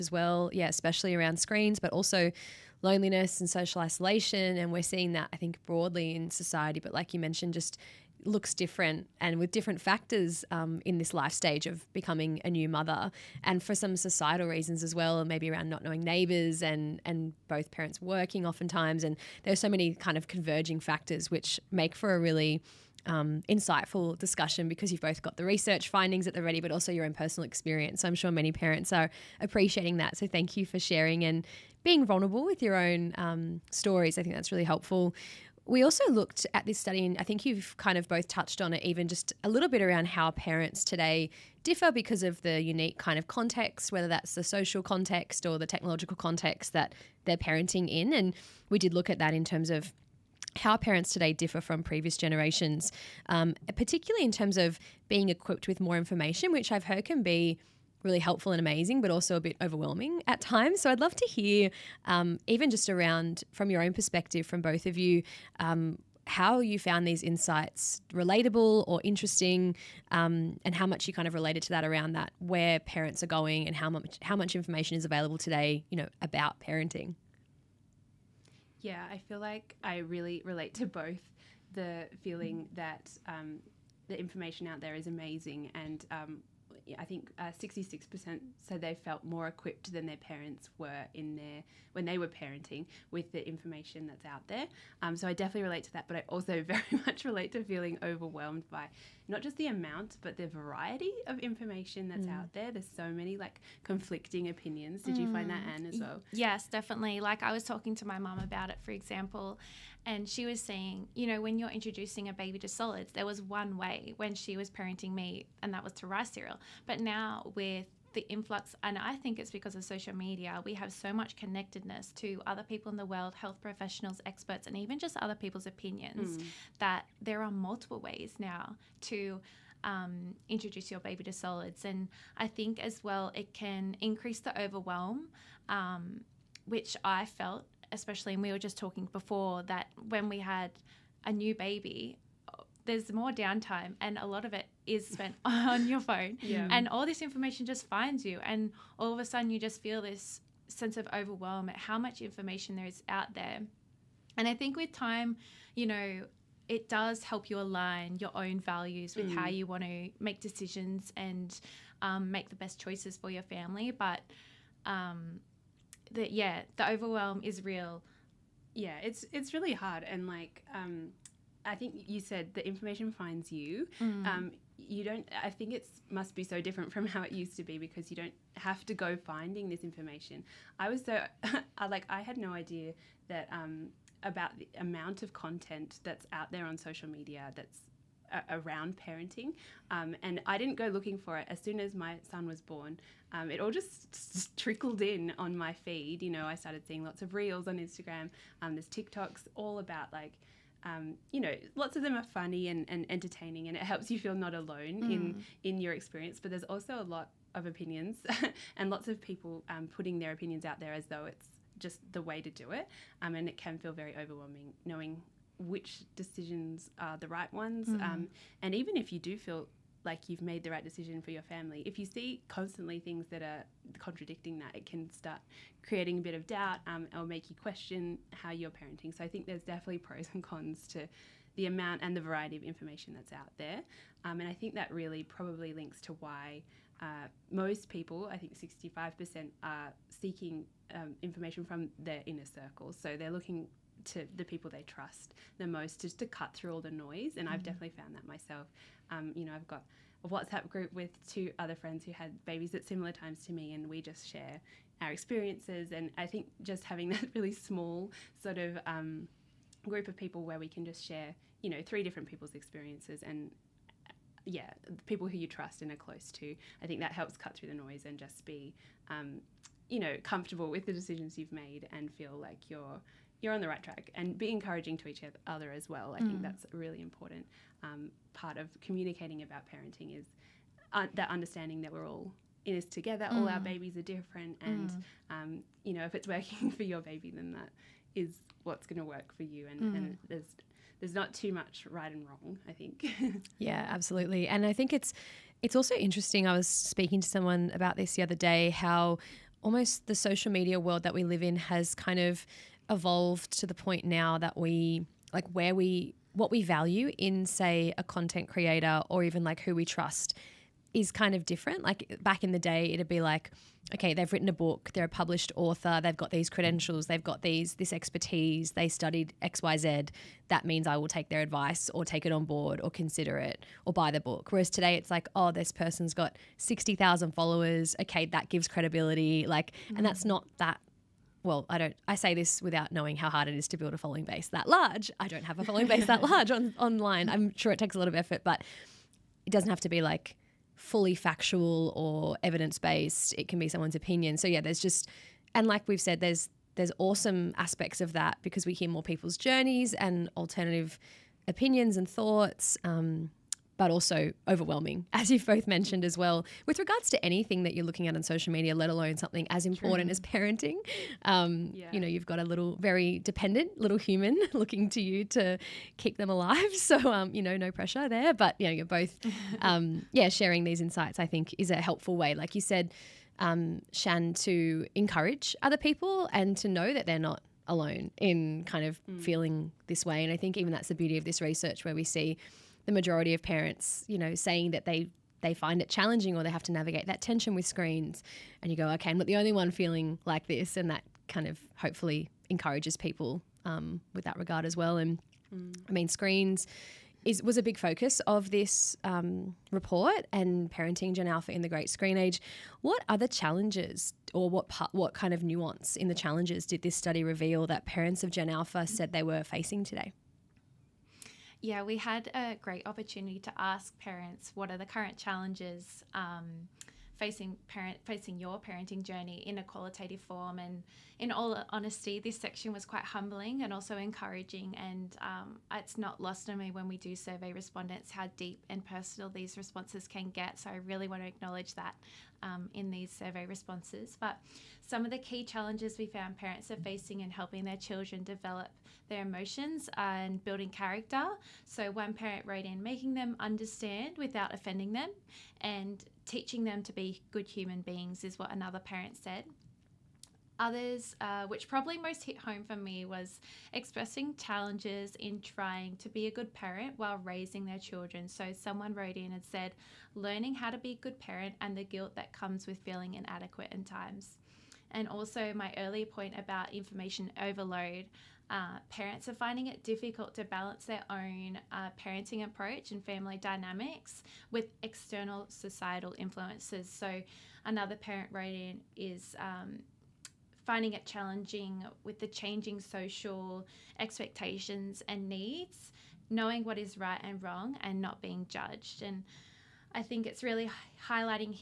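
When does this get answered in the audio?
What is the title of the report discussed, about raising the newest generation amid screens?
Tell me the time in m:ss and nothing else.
6:40.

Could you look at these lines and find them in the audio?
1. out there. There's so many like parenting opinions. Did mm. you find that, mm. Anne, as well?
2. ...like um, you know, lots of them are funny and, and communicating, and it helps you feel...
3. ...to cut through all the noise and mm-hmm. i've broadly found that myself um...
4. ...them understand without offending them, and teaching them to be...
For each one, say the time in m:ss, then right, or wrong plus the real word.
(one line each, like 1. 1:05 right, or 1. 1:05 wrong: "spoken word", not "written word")
1. 1:42 wrong: "conflicting", not "parenting"
2. 3:20 wrong: "entertaining", not "communicating"
3. 4:06 wrong: "definitely", not "broadly"
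4. 7:23 right.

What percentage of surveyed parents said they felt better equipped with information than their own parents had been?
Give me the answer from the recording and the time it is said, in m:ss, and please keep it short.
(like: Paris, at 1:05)
66%, at 1:27.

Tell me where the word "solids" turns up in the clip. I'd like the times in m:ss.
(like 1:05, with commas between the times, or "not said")
1:52, 2:11.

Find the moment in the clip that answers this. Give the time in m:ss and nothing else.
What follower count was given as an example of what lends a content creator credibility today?
5:26.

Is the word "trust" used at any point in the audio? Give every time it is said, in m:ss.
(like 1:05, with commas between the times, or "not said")
4:04, 4:25, 5:09.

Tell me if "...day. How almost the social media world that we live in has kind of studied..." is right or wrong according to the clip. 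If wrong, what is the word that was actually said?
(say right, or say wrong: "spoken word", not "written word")
wrong: "evolved", not "studied".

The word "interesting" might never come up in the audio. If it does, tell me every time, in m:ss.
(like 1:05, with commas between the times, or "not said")
1:09, 4:55.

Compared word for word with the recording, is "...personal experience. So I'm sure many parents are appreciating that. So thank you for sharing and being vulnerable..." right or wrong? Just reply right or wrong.
right.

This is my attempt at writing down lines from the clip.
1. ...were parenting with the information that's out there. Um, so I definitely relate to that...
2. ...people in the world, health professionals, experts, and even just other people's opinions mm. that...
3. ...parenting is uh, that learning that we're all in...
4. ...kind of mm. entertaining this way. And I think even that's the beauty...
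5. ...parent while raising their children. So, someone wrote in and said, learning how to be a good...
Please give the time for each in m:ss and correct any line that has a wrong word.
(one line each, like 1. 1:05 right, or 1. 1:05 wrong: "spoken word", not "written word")
1. 1:32 right
2. 2:02 right
3. 4:39 wrong: "understanding", not "learning"
4. 6:18 wrong: "feeling", not "entertaining"
5. 7:36 right.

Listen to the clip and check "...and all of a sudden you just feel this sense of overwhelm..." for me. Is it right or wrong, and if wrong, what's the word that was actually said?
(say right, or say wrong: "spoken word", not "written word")
right.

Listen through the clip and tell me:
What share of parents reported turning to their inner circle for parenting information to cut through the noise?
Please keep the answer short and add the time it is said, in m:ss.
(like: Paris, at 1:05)
65%, at 3:58.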